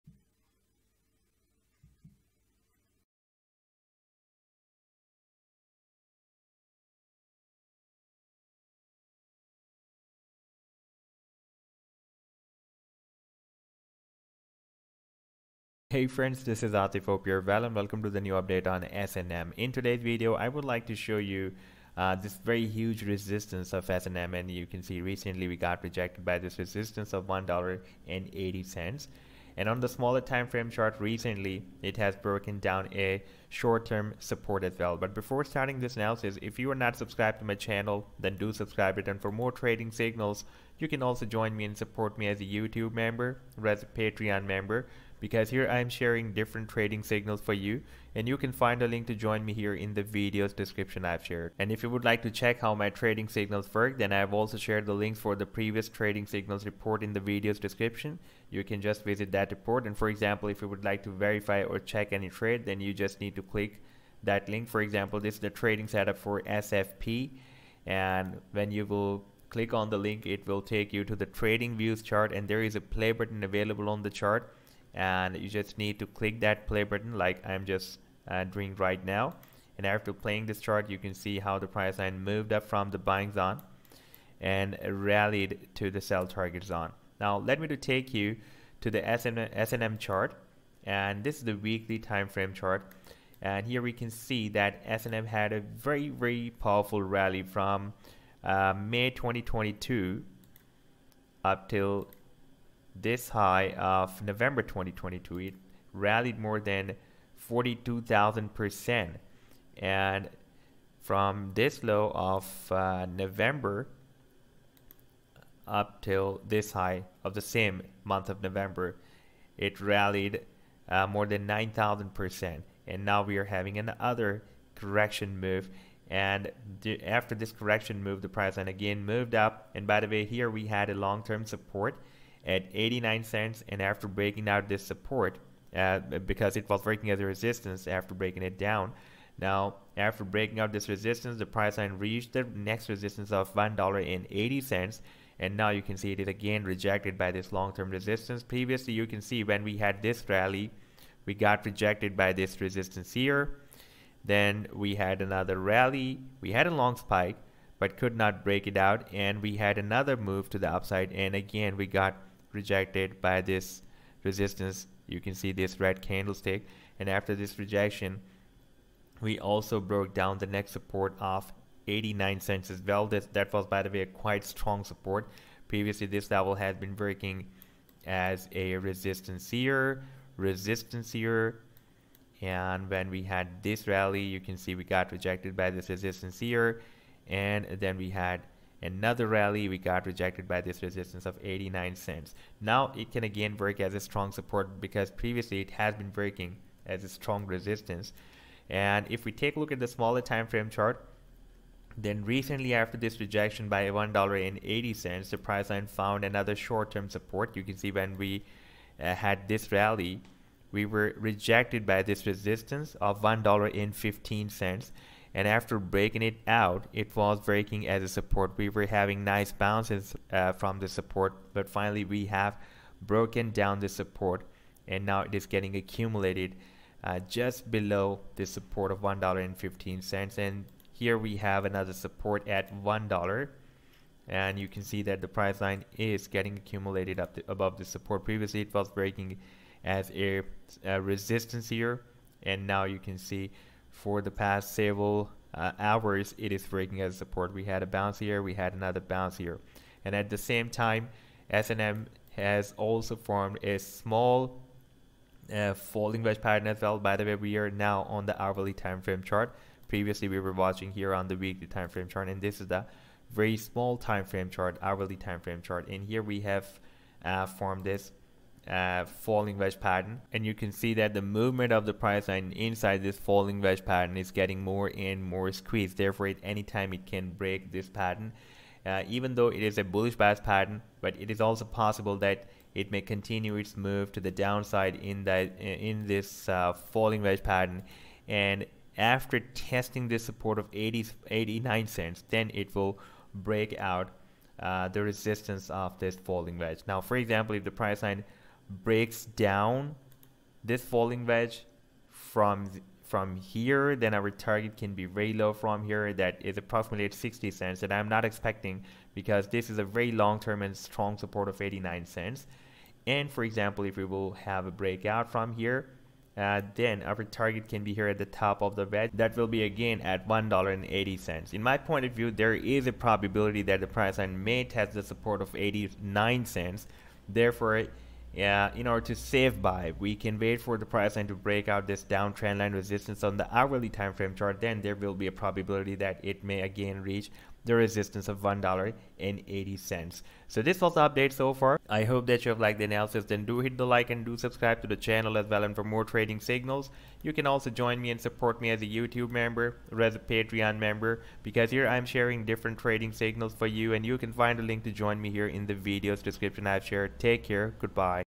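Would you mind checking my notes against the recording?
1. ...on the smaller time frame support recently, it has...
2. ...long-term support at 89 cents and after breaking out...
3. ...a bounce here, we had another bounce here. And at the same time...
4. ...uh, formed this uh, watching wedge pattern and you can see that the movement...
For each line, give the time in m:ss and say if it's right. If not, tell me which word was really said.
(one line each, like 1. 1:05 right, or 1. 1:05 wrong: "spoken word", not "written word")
1. 0:29 wrong: "chart", not "support"
2. 2:10 right
3. 4:07 right
4. 4:27 wrong: "falling", not "watching".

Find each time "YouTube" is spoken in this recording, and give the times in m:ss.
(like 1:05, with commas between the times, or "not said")
0:42, 5:48.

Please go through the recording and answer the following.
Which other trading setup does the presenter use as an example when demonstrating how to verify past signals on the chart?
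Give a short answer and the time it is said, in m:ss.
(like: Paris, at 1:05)
SFP, at 1:06.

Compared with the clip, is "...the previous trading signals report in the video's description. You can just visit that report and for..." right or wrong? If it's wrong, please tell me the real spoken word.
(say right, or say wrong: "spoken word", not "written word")
right.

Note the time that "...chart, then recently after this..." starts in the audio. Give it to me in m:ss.
3:20.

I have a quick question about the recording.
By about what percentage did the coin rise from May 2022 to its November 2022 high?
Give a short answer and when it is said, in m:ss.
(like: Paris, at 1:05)
42,000%, at 1:47.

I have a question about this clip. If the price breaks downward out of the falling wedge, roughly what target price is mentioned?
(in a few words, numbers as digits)
60 cents.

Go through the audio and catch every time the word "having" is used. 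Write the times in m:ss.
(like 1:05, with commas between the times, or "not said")
2:03, 3:38.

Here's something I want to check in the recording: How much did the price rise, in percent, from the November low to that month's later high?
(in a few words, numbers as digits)
9,000%.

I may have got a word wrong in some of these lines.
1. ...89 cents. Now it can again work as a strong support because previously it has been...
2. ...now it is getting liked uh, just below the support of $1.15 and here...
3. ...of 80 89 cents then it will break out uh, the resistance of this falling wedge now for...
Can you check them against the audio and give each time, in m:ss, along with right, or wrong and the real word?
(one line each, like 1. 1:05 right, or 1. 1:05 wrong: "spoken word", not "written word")
1. 3:11 right
2. 3:45 wrong: "accumulated", not "liked"
3. 4:50 right.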